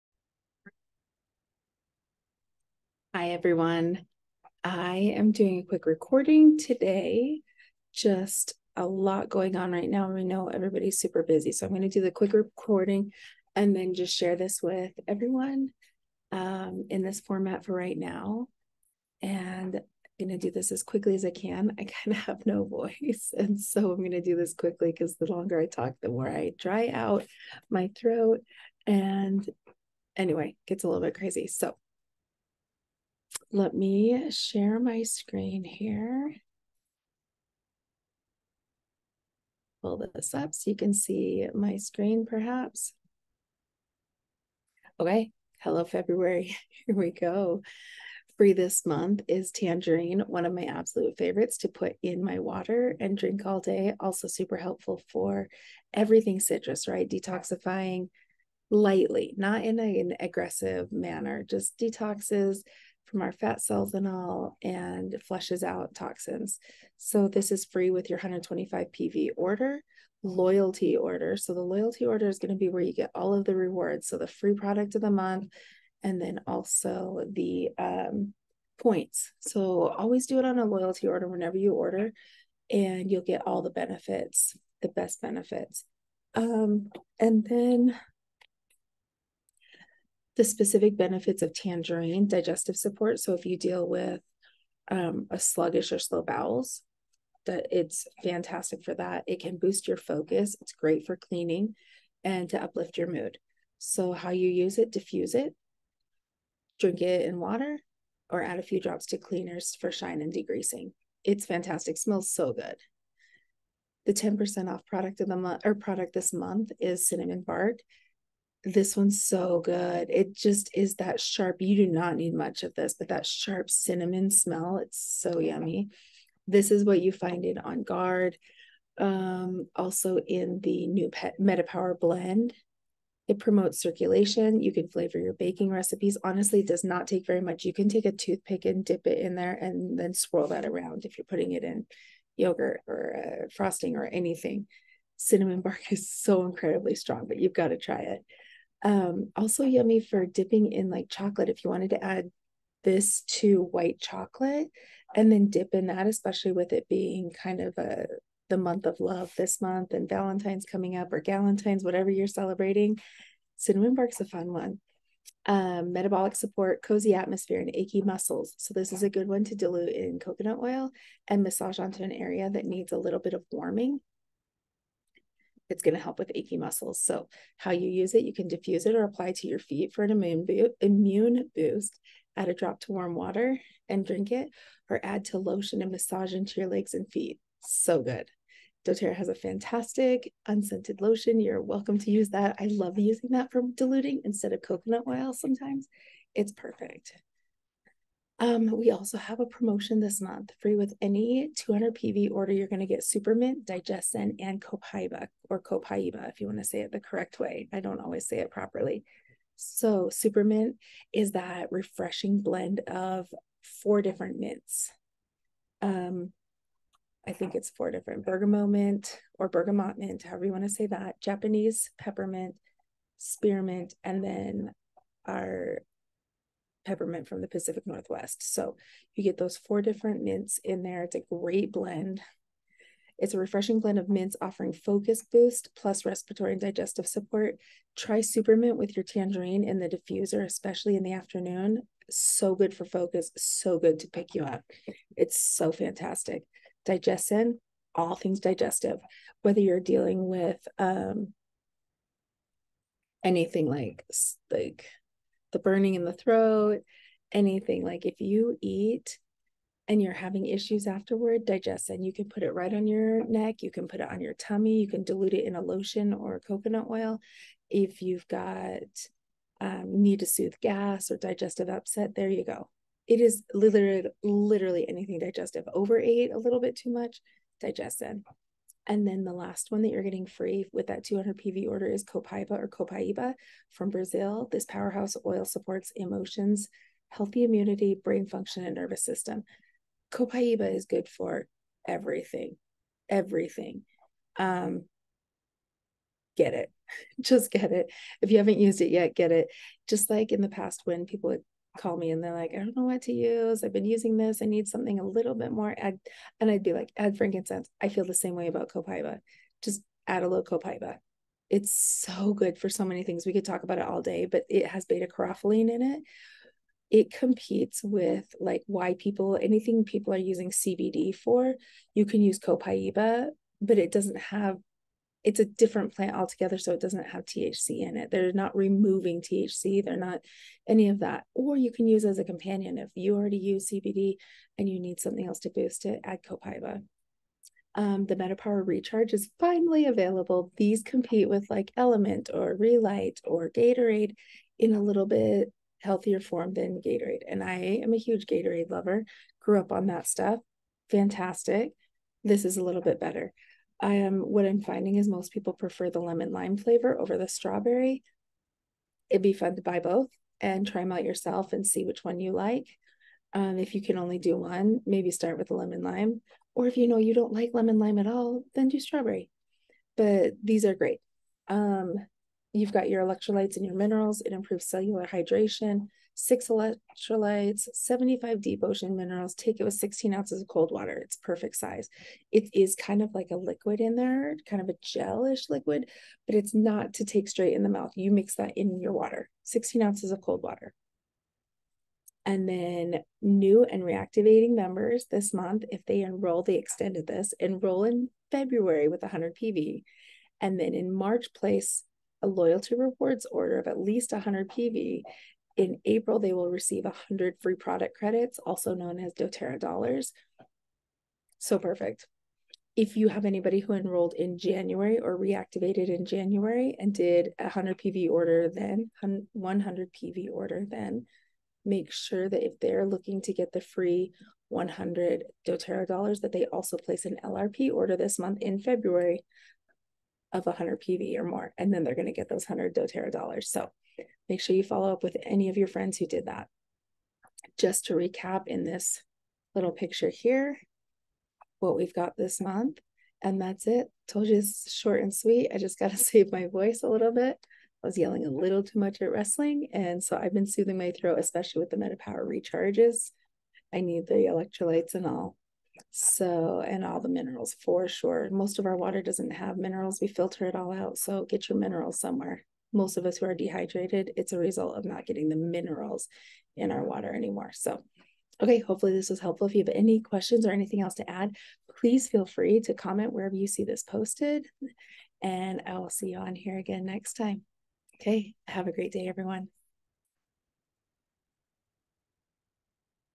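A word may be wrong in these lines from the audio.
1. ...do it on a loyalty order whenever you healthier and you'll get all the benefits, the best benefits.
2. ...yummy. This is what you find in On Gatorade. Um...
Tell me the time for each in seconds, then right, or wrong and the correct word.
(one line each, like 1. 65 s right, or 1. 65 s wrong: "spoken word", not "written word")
1. 80 s wrong: "order", not "healthier"
2. 125 s wrong: "Guard", not "Gatorade".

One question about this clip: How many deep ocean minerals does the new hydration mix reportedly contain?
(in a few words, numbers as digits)
75.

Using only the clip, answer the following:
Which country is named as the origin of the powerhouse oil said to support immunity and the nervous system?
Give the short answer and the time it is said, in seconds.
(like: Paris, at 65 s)
Brazil, at 283 s.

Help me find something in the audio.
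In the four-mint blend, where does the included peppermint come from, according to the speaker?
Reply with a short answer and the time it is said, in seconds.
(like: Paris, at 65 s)
Pacific Northwest, at 227 s.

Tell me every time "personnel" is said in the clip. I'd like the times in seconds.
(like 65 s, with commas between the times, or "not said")
not said.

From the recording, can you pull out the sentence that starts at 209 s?
So, Supermint is that refreshing blend of four different mints.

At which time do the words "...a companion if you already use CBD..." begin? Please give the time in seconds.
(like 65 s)
332 s.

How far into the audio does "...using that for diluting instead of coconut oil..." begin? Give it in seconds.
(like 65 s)
192 s.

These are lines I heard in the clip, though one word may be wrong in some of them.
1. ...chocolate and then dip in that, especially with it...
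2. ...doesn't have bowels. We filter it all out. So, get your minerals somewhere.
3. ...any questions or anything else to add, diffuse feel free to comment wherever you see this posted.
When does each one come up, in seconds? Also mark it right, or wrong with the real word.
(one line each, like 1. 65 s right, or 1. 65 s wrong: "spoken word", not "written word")
1. 153 s right
2. 459 s wrong: "minerals", not "bowels"
3. 469 s wrong: "please", not "diffuse".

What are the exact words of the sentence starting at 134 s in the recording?
You can flavor your baking recipes.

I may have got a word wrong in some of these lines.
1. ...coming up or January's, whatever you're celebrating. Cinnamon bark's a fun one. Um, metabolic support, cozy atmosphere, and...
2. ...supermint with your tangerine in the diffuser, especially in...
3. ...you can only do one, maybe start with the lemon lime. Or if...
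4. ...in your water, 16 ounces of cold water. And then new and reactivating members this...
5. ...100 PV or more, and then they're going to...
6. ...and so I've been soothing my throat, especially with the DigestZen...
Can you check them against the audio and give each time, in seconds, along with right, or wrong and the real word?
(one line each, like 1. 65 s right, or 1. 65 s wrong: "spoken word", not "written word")
1. 160 s wrong: "Galentine", not "January"
2. 238 s right
3. 363 s right
4. 388 s right
5. 430 s right
6. 449 s wrong: "MetaPower", not "DigestZen".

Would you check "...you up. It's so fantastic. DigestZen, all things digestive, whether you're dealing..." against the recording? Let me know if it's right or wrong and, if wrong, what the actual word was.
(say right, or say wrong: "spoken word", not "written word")
right.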